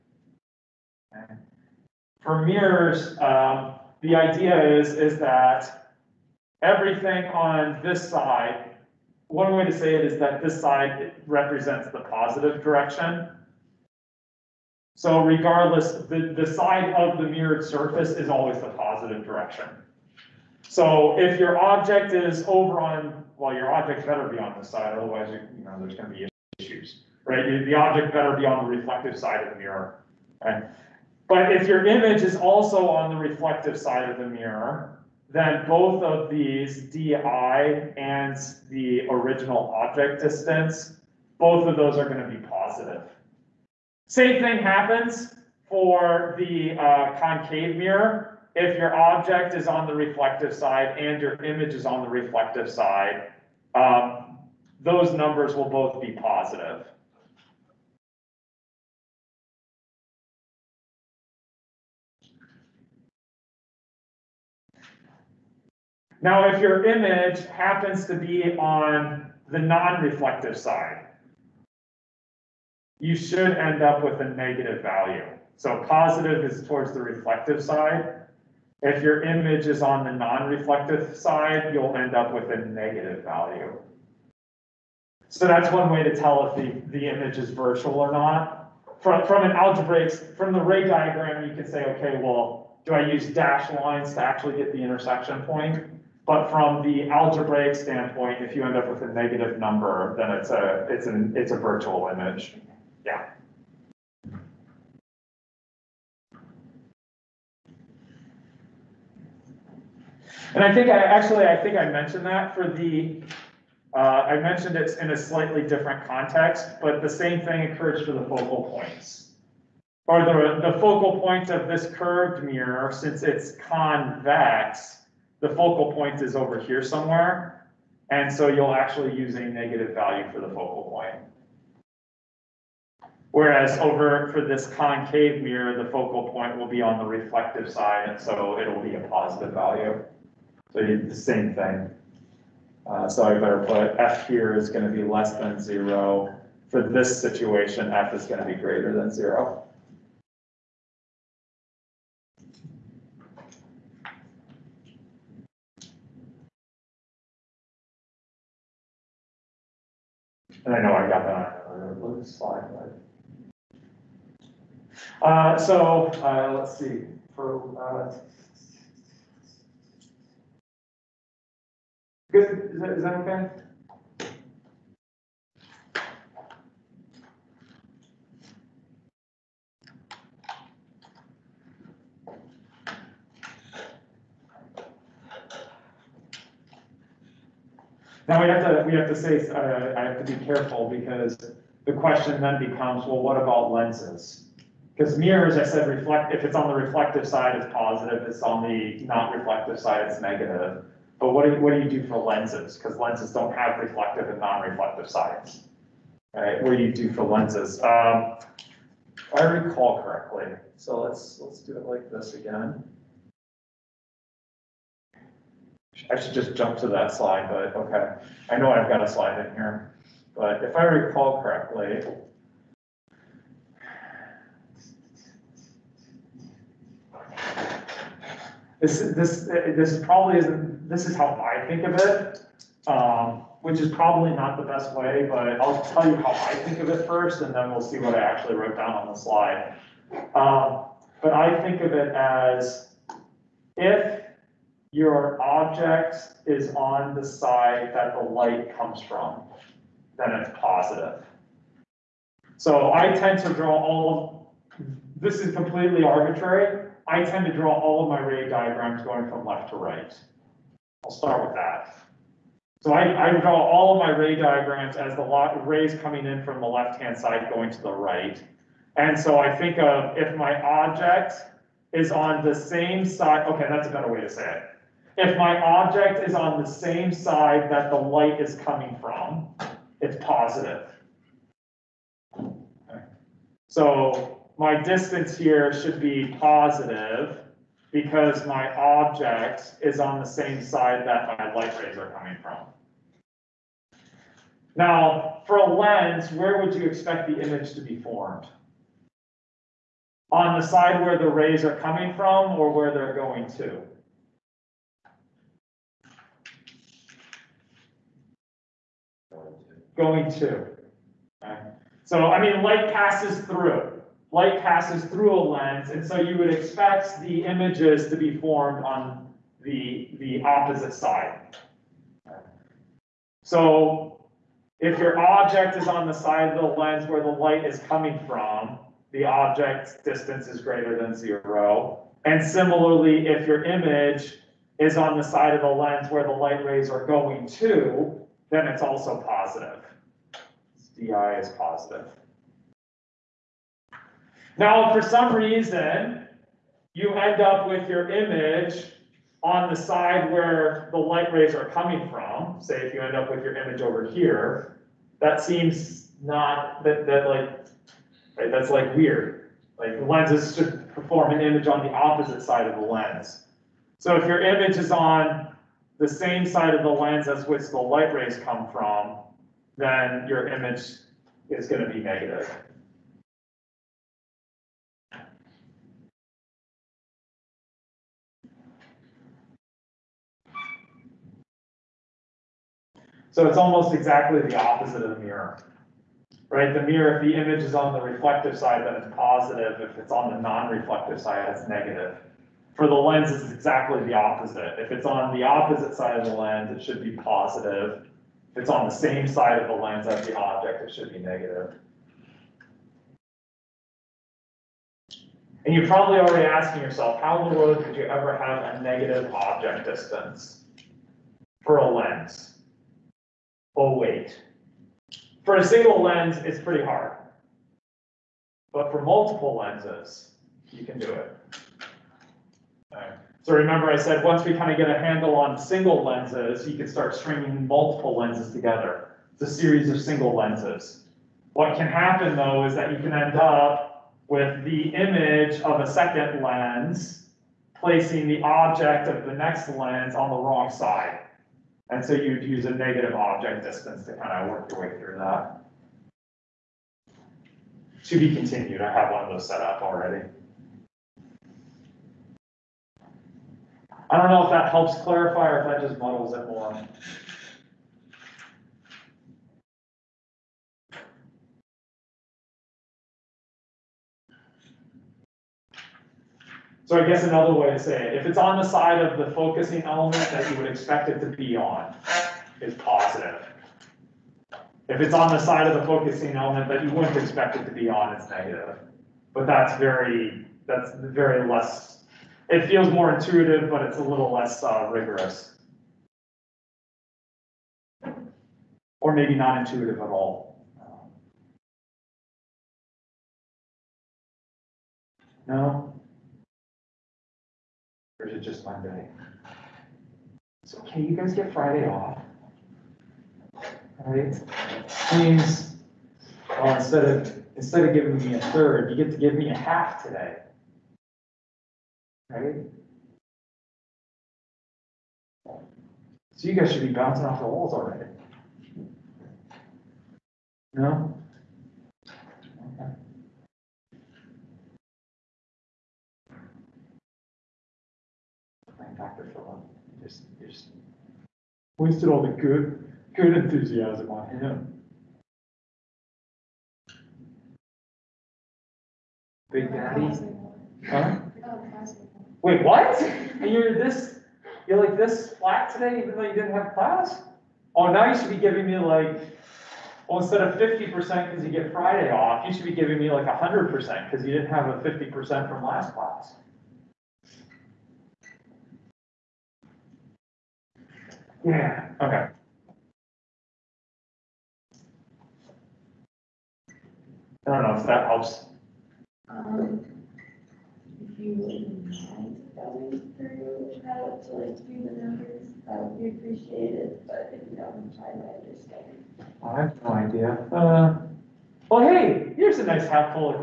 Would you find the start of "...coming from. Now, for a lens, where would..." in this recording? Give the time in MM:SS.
04:52.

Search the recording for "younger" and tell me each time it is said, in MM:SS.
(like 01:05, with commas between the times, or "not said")
not said.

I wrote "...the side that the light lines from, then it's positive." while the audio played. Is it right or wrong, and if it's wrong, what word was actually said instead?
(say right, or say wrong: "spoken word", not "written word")
wrong: "comes", not "lines".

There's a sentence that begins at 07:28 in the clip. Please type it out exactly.
To be continued, I have one of those set up already.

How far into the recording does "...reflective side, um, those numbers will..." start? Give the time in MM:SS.
00:52.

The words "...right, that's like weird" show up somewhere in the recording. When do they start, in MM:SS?
05:58.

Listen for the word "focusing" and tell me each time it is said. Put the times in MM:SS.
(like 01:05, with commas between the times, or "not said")
07:49, 07:55.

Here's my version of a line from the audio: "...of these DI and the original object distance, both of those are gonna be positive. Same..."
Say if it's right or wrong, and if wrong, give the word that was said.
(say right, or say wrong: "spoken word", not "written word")
right.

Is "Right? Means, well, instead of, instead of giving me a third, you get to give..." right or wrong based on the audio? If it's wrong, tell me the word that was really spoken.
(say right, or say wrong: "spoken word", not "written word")
right.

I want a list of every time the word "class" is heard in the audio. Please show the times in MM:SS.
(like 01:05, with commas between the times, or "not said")
09:06, 09:15.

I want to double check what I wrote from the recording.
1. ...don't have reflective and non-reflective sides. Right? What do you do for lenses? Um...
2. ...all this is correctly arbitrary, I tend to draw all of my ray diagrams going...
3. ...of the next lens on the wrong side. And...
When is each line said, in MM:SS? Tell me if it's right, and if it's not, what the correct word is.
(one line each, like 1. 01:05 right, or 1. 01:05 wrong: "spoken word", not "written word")
1. 03:23 right
2. 04:13 wrong: "completely", not "correctly"
3. 07:19 right.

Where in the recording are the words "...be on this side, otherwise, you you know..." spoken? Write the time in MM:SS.
00:24.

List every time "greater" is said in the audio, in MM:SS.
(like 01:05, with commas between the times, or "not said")
02:28, 05:30.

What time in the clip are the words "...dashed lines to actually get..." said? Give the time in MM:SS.
01:33.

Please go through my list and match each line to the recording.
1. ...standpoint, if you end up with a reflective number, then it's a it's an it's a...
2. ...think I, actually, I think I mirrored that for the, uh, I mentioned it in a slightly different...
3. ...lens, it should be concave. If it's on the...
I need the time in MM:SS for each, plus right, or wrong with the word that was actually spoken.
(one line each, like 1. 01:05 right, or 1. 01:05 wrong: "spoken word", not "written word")
1. 01:37 wrong: "negative", not "reflective"
2. 01:50 wrong: "mentioned", not "mirrored"
3. 06:36 wrong: "positive", not "concave".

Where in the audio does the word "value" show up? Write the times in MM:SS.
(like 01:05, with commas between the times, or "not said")
01:14, 01:23, 02:09, 02:19.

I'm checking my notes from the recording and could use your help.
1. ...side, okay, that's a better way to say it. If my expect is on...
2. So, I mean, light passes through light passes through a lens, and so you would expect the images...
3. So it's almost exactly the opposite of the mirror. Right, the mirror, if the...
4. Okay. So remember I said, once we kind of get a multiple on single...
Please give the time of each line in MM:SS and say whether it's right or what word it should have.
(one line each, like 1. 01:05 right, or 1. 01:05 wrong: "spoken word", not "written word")
1. 04:33 wrong: "object", not "expect"
2. 05:12 right
3. 06:23 right
4. 07:02 wrong: "handle", not "multiple".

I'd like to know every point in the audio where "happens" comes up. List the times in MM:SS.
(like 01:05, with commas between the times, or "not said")
00:44, 01:07, 07:11.